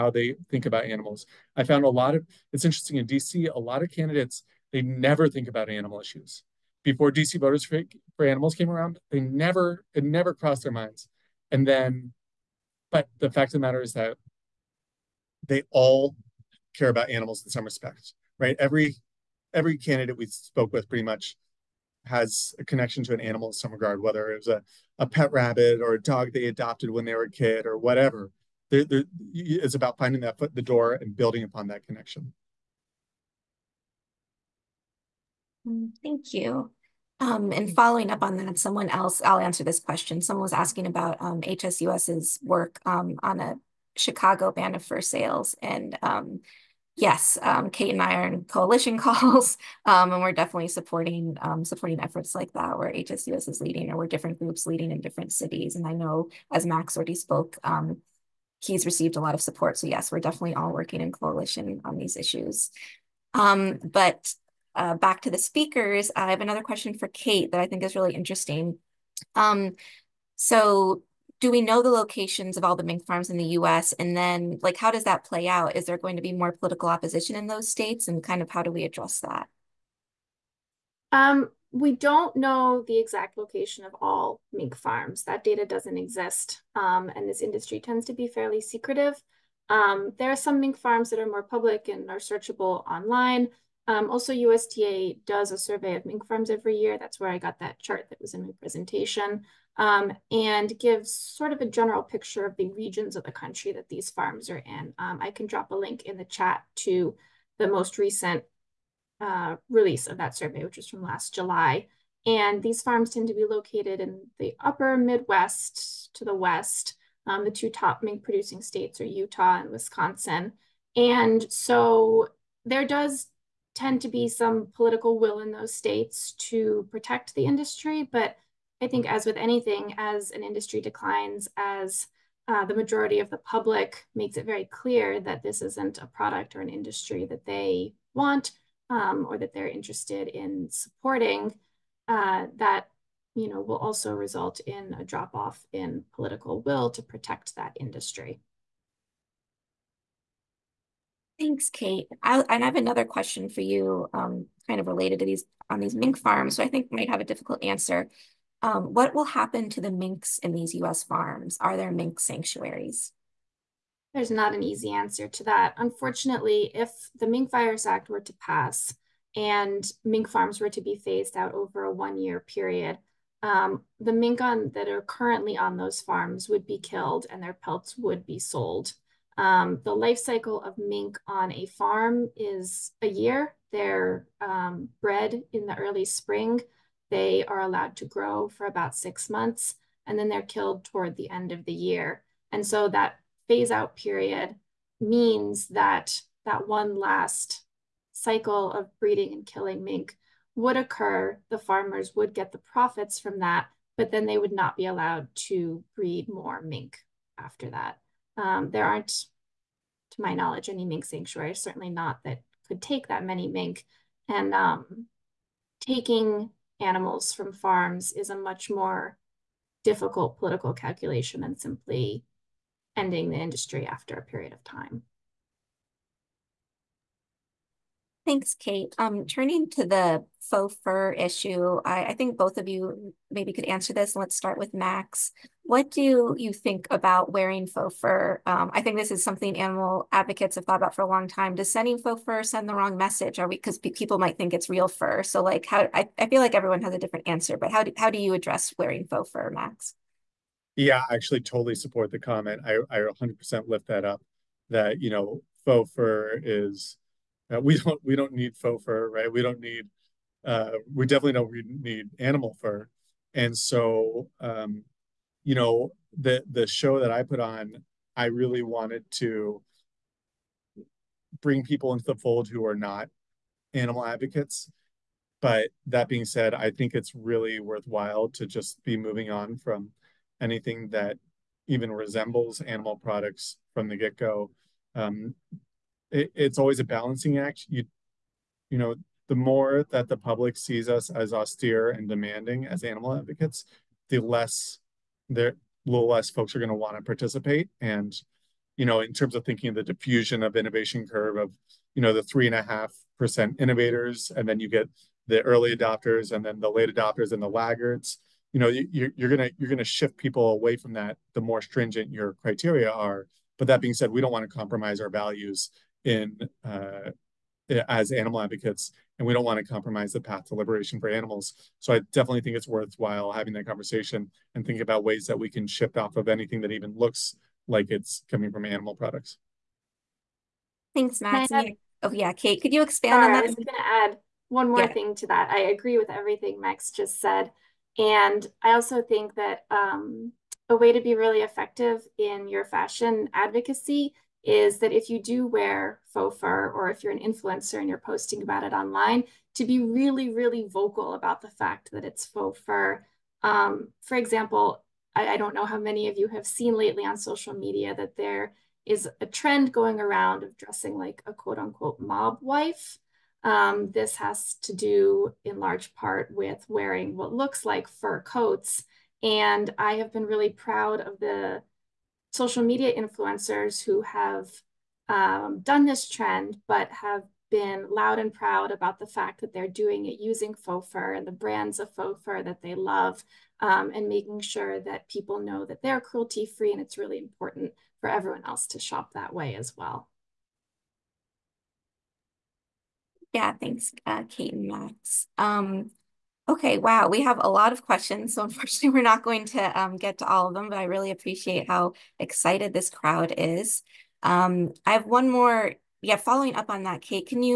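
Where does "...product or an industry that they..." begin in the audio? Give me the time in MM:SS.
02:16.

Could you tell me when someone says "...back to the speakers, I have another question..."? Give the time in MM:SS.
01:04.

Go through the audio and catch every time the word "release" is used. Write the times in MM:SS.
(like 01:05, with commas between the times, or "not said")
01:49.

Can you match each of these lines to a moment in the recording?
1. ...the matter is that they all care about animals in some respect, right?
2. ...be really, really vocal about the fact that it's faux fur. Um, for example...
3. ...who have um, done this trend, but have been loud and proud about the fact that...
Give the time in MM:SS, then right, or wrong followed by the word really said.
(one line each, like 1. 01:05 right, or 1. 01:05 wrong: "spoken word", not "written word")
1. 00:13 right
2. 05:49 right
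3. 06:13 right.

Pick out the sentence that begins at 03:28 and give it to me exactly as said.
Um, there aren't, to my knowledge, any mink sanctuaries, certainly not that could take that many mink.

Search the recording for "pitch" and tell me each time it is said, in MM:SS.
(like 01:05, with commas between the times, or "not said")
not said.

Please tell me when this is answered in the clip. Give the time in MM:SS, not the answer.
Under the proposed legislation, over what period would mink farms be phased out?
02:51.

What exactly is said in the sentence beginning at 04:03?
Are we because people might think it's real fur?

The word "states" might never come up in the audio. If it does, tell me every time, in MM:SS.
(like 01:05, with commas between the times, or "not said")
01:17, 01:58, 02:05.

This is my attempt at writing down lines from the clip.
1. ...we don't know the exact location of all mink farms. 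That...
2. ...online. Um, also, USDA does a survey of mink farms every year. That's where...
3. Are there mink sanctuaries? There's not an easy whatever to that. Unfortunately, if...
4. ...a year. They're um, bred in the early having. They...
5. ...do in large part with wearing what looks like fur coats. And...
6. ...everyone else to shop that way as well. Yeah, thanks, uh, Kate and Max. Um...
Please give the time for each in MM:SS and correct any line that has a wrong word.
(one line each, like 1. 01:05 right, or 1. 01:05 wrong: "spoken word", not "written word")
1. 01:21 right
2. 01:32 right
3. 02:41 wrong: "answer", not "whatever"
4. 03:03 wrong: "spring", not "having"
5. 06:04 right
6. 06:28 right.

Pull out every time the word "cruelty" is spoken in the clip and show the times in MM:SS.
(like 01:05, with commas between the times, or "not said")
06:25.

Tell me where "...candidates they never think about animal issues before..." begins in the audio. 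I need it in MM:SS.
00:03.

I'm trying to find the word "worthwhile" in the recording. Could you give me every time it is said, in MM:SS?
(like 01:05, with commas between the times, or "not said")
04:37, 05:22.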